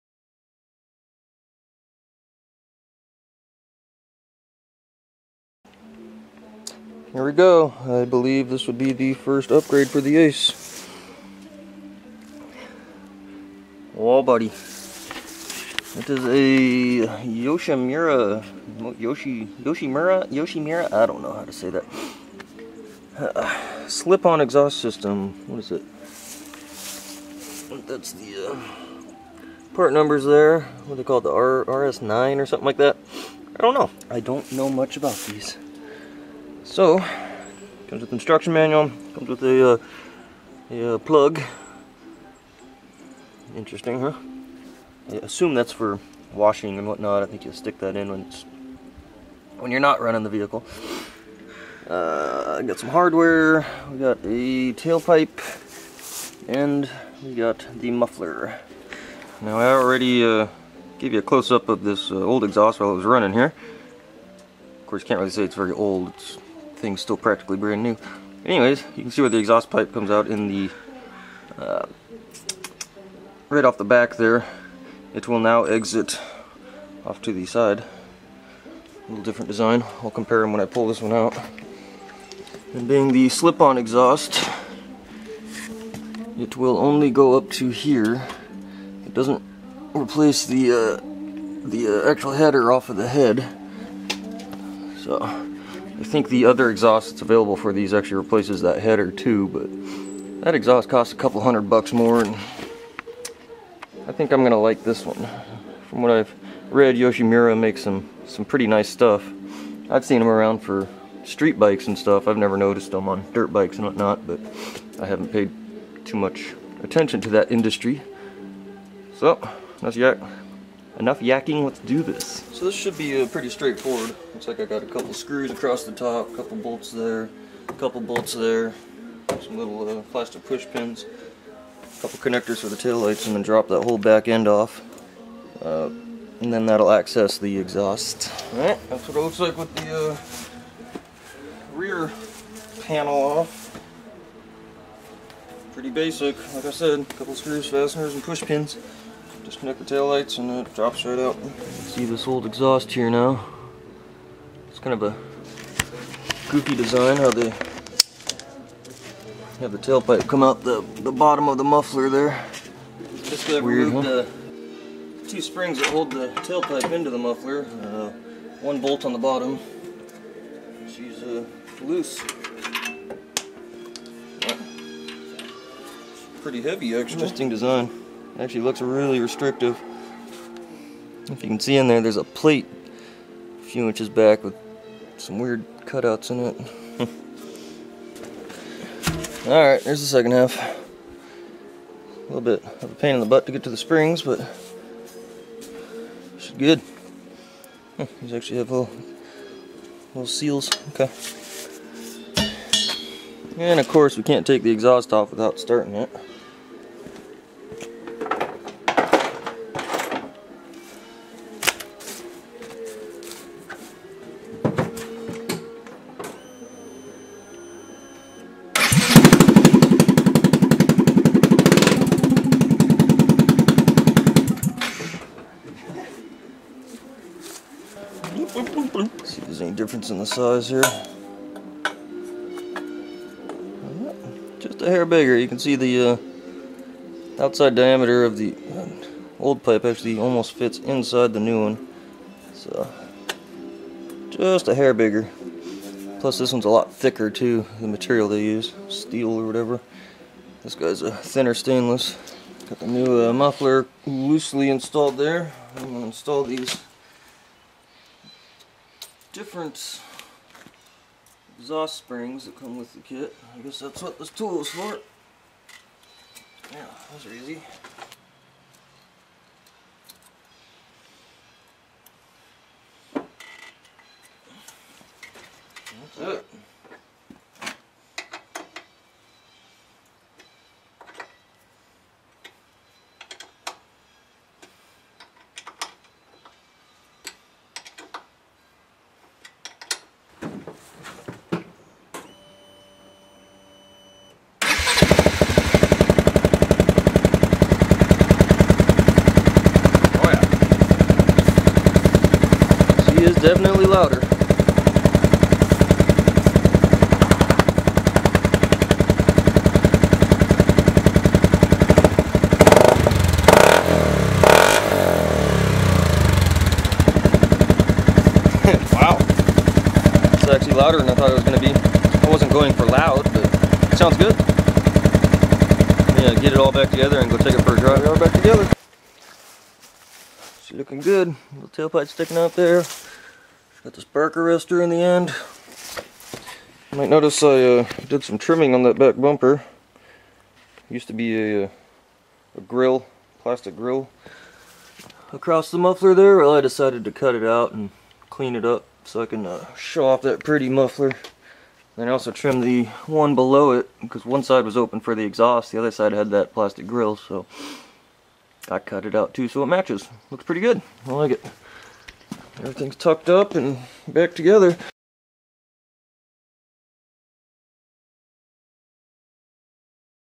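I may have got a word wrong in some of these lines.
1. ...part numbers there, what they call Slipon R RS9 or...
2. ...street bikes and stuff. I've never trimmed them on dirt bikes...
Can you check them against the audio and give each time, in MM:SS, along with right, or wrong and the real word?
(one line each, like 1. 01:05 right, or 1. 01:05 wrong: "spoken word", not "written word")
1. 00:29 wrong: "The", not "Slipon"
2. 01:51 wrong: "noticed", not "trimmed".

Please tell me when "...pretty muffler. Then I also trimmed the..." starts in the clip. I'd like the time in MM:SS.
05:50.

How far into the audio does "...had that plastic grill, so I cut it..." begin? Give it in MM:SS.
05:56.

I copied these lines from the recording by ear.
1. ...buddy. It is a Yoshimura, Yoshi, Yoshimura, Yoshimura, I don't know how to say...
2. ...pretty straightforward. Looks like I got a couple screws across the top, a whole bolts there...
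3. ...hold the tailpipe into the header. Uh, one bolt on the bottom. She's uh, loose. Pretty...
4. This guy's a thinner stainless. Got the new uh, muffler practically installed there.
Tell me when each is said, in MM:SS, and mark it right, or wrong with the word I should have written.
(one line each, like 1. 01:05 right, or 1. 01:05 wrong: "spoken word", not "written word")
1. 00:14 right
2. 02:03 wrong: "couple", not "whole"
3. 02:45 wrong: "muffler", not "header"
4. 04:10 wrong: "loosely", not "practically".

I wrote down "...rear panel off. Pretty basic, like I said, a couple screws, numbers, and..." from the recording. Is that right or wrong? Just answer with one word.
wrong.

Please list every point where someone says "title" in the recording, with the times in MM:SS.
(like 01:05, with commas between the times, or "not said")
not said.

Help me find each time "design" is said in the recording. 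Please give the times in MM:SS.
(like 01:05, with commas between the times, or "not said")
01:19, 02:36, 02:57.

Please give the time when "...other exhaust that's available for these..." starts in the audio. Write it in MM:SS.
01:36.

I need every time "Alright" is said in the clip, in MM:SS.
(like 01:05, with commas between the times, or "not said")
02:18, 03:09.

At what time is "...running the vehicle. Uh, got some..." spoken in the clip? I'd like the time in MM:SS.
00:50.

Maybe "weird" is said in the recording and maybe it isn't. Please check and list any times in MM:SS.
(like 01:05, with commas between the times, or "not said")
03:05.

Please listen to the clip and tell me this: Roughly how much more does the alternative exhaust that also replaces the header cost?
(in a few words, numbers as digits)
a couple hundred bucks.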